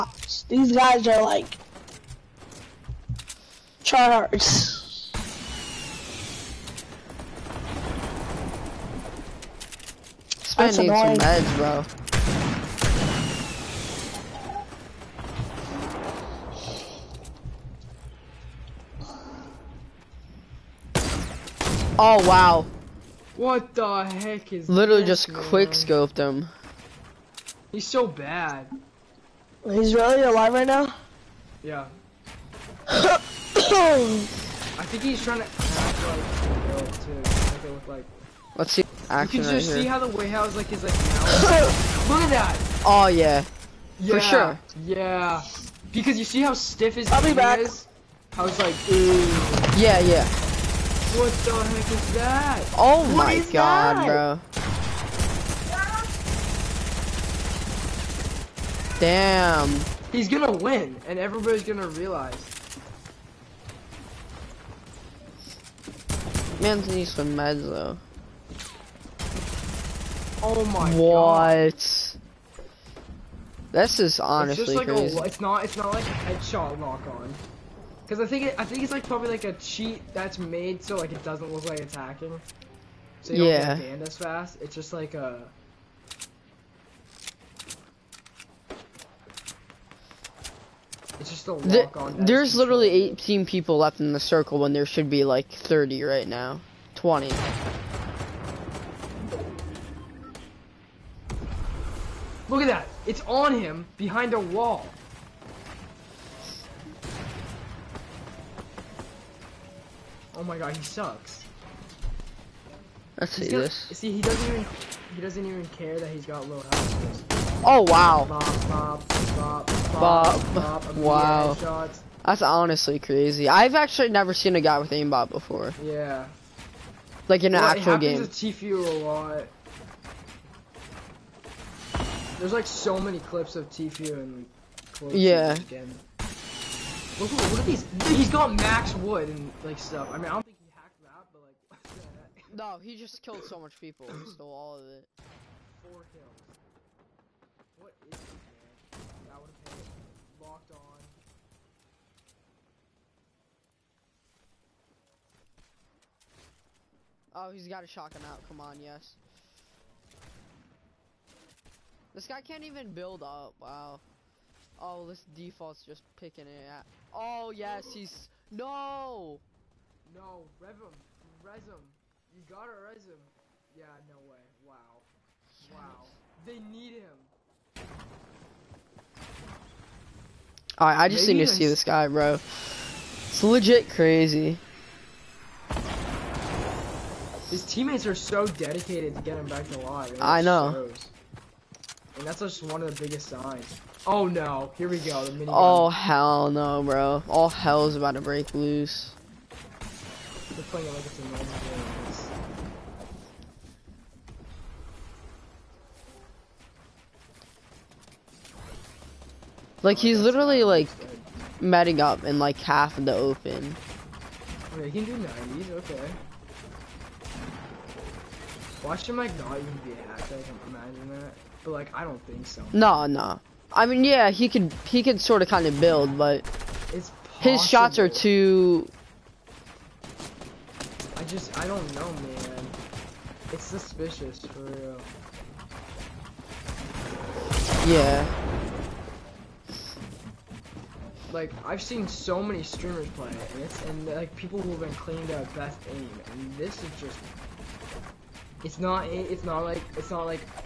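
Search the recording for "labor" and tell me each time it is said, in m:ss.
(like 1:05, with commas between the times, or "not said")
not said.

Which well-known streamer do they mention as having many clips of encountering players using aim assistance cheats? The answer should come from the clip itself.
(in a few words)
Tfue.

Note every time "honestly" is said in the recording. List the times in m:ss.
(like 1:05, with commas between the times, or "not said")
1:14, 2:02.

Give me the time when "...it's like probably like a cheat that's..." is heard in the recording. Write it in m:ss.
1:18.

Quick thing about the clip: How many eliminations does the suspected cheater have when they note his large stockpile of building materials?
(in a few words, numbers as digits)
4.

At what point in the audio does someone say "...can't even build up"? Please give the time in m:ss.
2:42.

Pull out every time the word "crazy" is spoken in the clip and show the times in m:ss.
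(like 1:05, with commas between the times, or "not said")
1:14, 2:02, 3:03.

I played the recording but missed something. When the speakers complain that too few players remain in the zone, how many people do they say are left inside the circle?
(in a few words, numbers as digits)
18.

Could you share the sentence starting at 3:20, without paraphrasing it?
They're playing it like it's a normal game.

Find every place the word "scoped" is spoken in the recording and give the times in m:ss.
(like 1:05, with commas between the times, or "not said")
0:25.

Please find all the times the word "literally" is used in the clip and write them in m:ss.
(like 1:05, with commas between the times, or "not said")
0:24, 1:32, 3:30.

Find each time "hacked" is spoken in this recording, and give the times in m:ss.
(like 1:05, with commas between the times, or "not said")
2:20, 3:40.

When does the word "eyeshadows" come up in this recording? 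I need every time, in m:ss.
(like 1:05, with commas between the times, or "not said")
not said.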